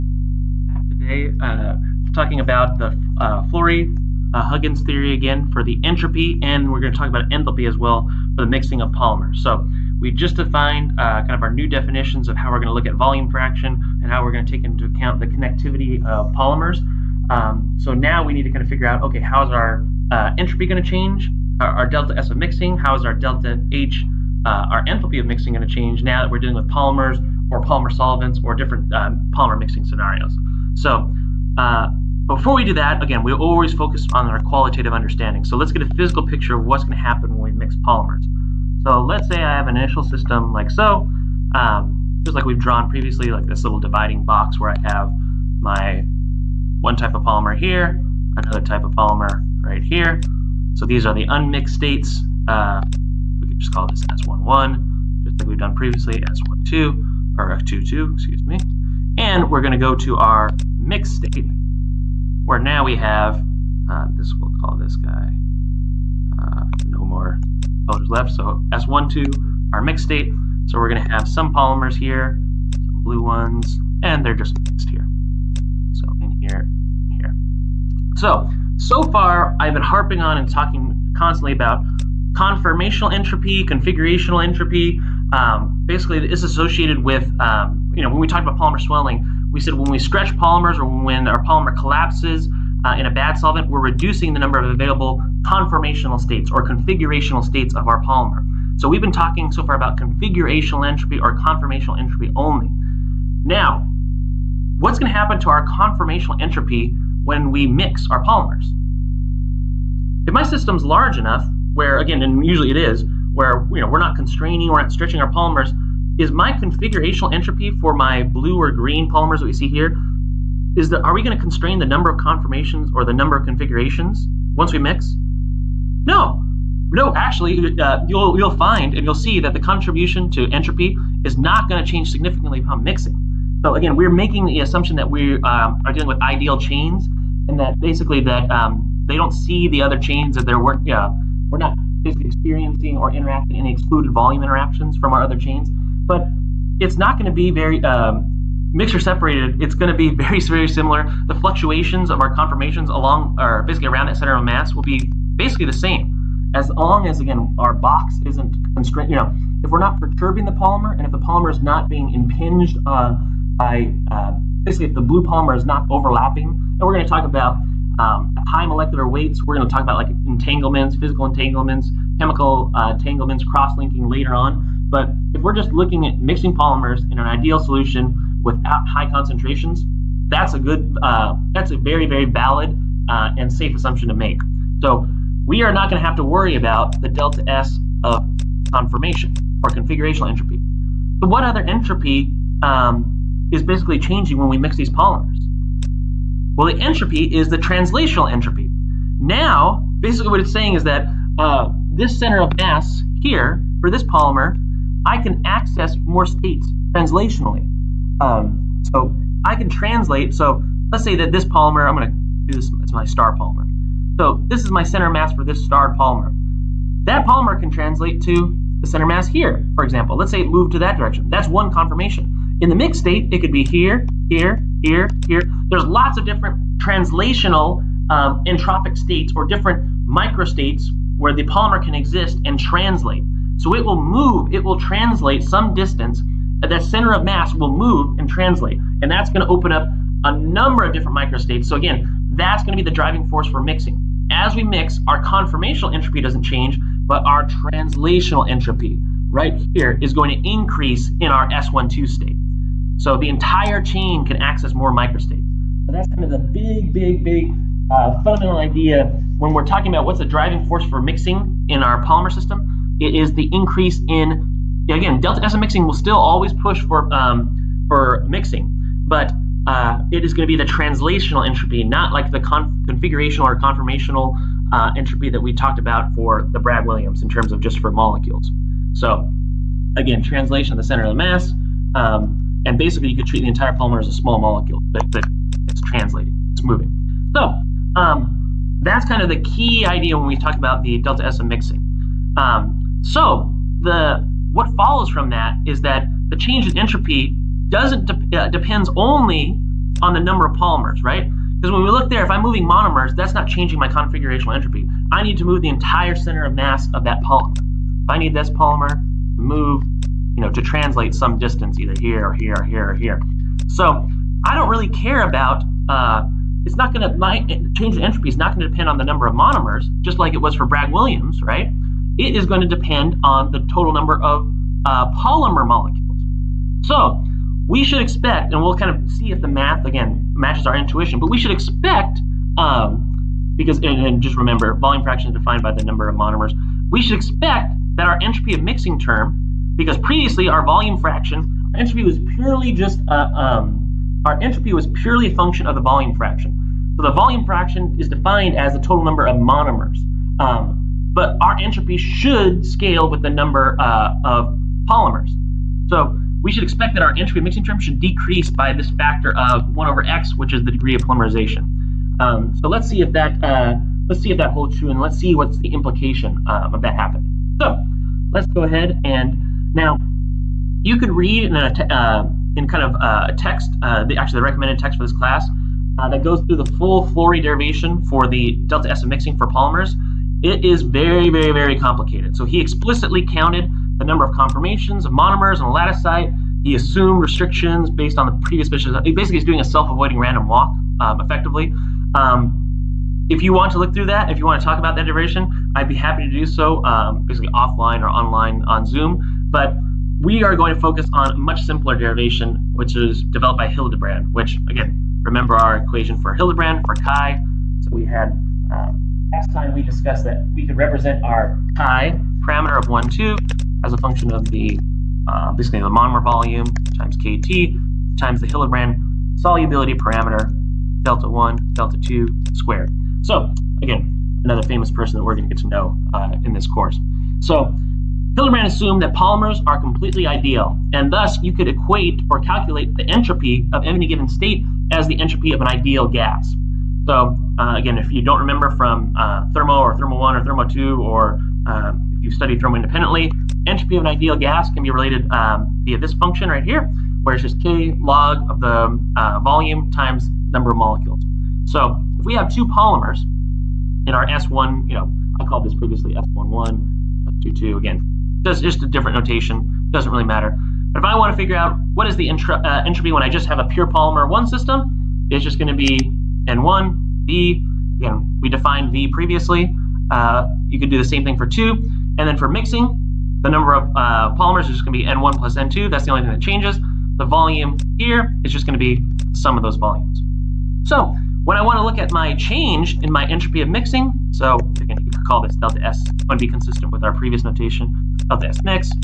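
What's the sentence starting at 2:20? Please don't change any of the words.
Yeah, we're not is experiencing or interacting any excluded volume interactions from our other chains.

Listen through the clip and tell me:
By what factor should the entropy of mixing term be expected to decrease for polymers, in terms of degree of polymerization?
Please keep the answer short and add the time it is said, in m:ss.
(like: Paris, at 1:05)
1 over x, at 5:59.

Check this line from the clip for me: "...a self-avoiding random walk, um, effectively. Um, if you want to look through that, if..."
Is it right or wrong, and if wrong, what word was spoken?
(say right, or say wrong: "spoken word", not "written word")
right.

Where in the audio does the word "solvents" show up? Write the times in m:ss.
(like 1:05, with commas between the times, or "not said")
0:27, 1:33.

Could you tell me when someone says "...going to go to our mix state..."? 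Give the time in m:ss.
0:59.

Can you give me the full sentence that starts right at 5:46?
So the volume fraction is defined as the total number of monomers.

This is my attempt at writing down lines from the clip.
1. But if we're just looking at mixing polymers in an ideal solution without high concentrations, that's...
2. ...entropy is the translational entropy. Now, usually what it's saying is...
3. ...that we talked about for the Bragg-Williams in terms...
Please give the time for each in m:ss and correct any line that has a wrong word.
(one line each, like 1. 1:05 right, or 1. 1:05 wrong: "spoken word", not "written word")
1. 2:54 right
2. 3:16 wrong: "basically", not "usually"
3. 4:35 right.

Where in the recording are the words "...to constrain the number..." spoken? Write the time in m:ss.
2:01.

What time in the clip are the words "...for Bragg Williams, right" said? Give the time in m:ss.
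5:20.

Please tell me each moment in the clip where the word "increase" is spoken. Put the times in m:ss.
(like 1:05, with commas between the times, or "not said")
4:10, 4:23.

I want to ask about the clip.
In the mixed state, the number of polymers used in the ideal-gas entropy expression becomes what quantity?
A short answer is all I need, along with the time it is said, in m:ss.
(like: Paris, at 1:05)
N1 plus N2, at 7:55.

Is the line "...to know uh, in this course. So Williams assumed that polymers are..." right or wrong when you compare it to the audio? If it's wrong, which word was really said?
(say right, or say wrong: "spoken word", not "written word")
wrong: "Hildebrand", not "Williams".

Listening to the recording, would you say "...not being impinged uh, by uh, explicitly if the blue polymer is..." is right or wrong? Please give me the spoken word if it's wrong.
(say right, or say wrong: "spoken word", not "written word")
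wrong: "basically", not "explicitly".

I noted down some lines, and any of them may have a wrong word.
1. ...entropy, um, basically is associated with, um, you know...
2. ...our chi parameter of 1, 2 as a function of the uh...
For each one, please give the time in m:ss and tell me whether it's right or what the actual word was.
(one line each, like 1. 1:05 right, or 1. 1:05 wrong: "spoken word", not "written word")
1. 1:24 right
2. 6:51 right.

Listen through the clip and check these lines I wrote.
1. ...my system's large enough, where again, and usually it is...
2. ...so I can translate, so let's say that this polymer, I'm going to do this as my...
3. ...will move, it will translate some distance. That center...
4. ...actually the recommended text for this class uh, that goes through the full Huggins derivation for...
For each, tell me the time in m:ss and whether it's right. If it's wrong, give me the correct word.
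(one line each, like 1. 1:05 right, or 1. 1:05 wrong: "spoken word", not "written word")
1. 1:50 right
2. 3:28 right
3. 3:53 right
4. 6:14 wrong: "Flory", not "Huggins".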